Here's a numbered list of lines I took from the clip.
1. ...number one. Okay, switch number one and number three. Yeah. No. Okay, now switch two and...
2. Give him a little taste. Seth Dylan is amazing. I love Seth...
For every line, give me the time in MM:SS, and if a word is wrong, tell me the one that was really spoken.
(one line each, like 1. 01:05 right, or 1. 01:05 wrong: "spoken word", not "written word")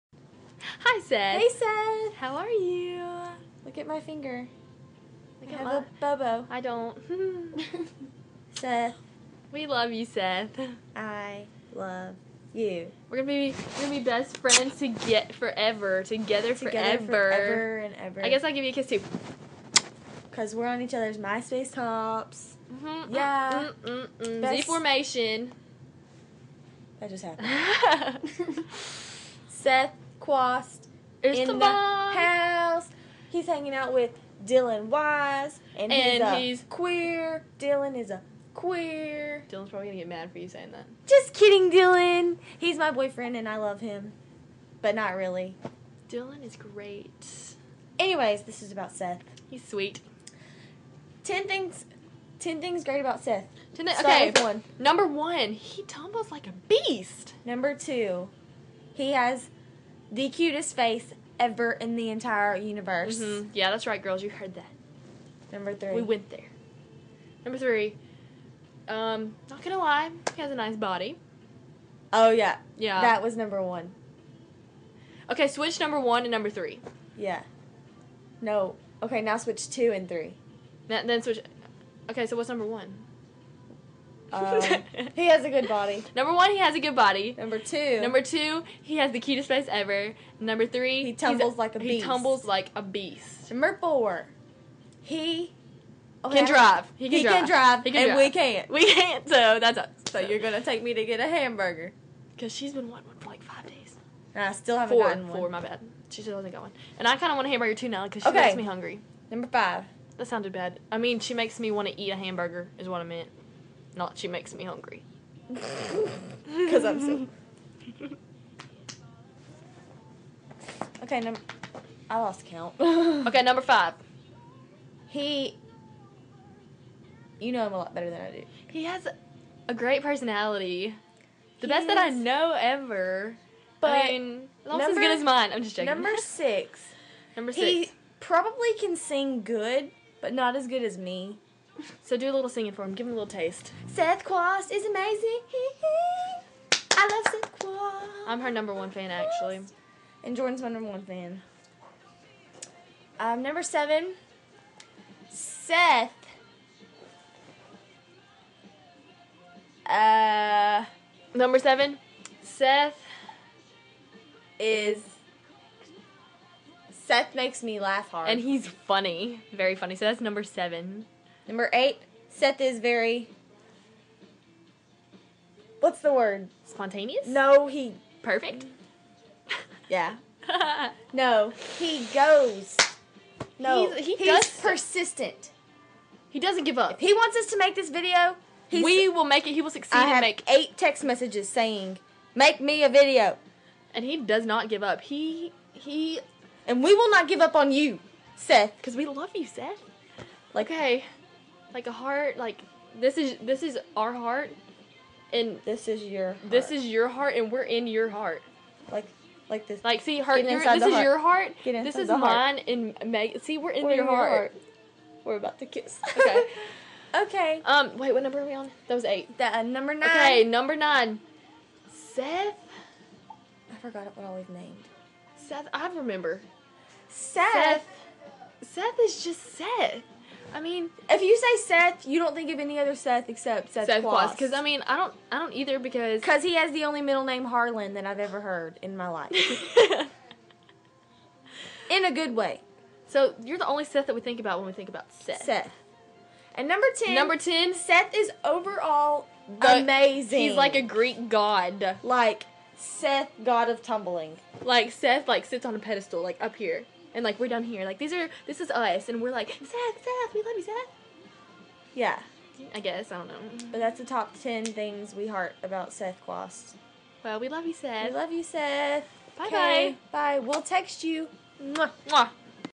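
1. 01:13 right
2. 02:22 wrong: "Quast", not "Dylan".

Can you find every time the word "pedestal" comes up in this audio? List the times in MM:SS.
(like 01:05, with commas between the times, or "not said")
04:15.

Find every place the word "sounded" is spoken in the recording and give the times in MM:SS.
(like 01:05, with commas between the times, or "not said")
01:50.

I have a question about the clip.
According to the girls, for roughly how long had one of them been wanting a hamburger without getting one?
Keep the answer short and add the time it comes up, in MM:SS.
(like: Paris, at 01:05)
5 days, at 01:43.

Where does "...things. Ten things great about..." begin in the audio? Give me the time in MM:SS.
00:51.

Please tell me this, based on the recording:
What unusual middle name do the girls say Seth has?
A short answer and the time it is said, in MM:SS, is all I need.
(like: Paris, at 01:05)
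Harlan, at 03:57.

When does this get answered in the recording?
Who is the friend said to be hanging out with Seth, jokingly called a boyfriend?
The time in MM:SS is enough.
00:34.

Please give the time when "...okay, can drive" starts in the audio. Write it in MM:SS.
01:36.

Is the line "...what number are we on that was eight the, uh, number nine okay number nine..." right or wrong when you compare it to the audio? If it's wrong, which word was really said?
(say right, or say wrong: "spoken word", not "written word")
right.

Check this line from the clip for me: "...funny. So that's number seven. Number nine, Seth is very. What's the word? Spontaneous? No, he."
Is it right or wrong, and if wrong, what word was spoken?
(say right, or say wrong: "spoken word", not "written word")
wrong: "eight", not "nine".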